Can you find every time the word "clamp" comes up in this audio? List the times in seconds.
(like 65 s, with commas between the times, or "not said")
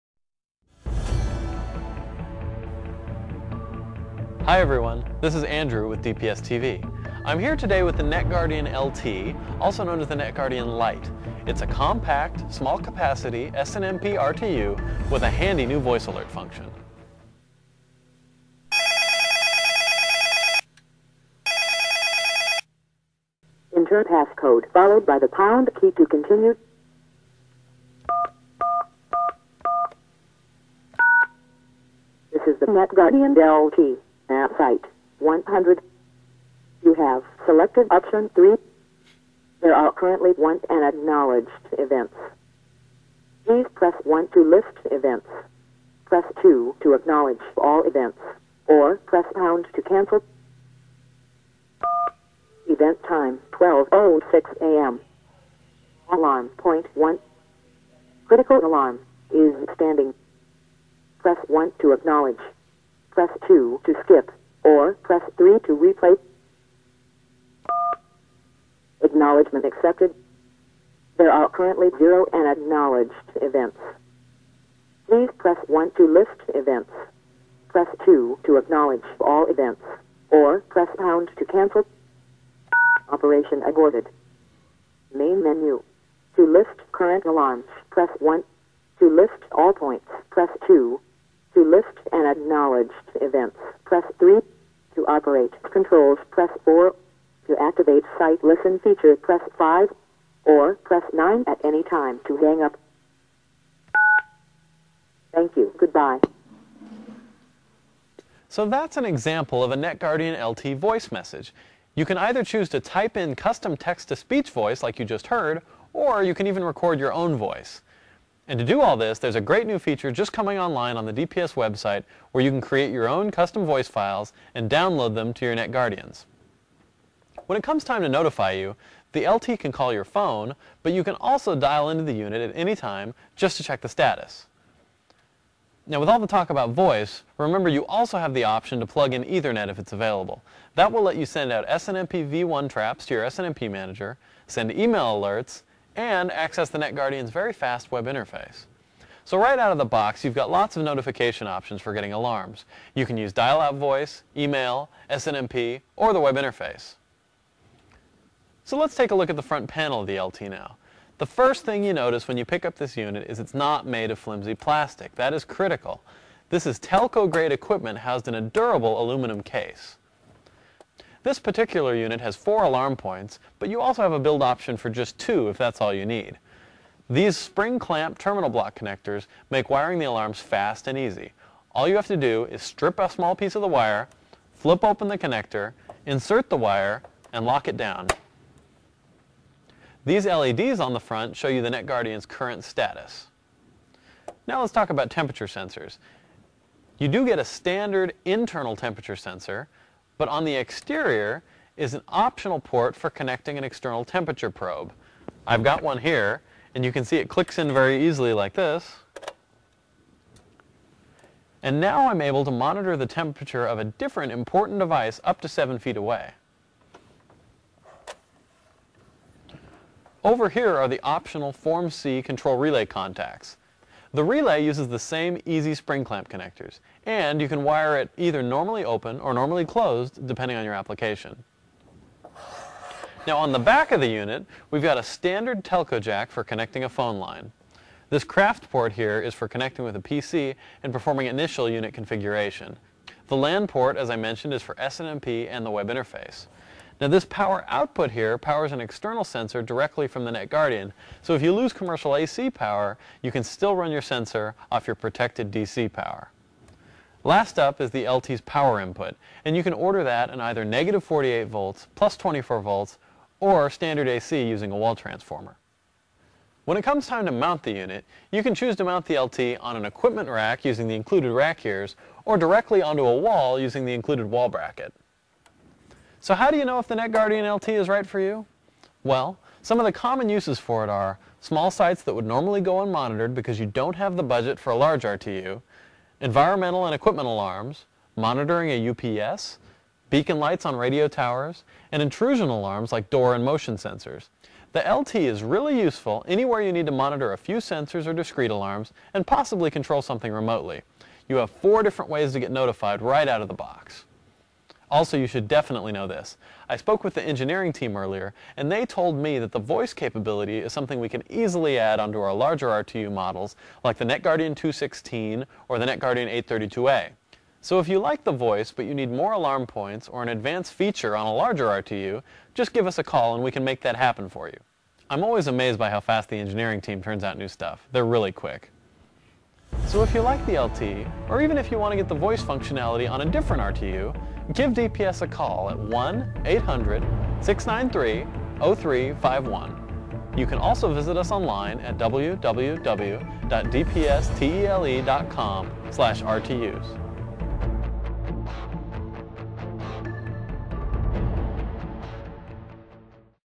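177 s, 226 s.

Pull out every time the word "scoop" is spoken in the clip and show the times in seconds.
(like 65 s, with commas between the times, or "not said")
not said.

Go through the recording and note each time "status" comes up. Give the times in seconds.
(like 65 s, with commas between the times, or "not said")
133 s, 192 s.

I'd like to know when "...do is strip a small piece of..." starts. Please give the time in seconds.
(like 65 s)
182 s.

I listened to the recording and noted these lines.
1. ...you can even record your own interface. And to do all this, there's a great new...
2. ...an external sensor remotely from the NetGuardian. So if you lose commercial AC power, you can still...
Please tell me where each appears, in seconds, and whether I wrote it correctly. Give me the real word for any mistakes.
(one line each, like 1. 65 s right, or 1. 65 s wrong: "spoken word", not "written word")
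1. 116 s wrong: "voice", not "interface"
2. 248 s wrong: "directly", not "remotely".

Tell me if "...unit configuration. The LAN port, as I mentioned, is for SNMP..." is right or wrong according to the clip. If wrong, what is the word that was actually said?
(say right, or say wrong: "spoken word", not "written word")
right.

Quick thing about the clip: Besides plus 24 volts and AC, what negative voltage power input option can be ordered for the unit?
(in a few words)
-48 volts.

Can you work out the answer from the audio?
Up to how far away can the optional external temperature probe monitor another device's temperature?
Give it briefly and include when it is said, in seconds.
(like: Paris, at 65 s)
7 feet, at 215 s.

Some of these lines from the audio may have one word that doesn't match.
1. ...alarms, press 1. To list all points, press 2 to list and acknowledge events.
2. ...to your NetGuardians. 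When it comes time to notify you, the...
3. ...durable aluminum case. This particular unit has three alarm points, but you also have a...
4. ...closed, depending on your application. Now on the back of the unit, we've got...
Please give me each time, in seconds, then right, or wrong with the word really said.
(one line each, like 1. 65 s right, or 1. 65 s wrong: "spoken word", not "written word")
1. 87 s right
2. 125 s right
3. 168 s wrong: "four", not "three"
4. 229 s right.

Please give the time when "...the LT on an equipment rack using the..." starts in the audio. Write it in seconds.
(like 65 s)
269 s.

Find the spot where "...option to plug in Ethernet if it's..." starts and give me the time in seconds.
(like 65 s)
138 s.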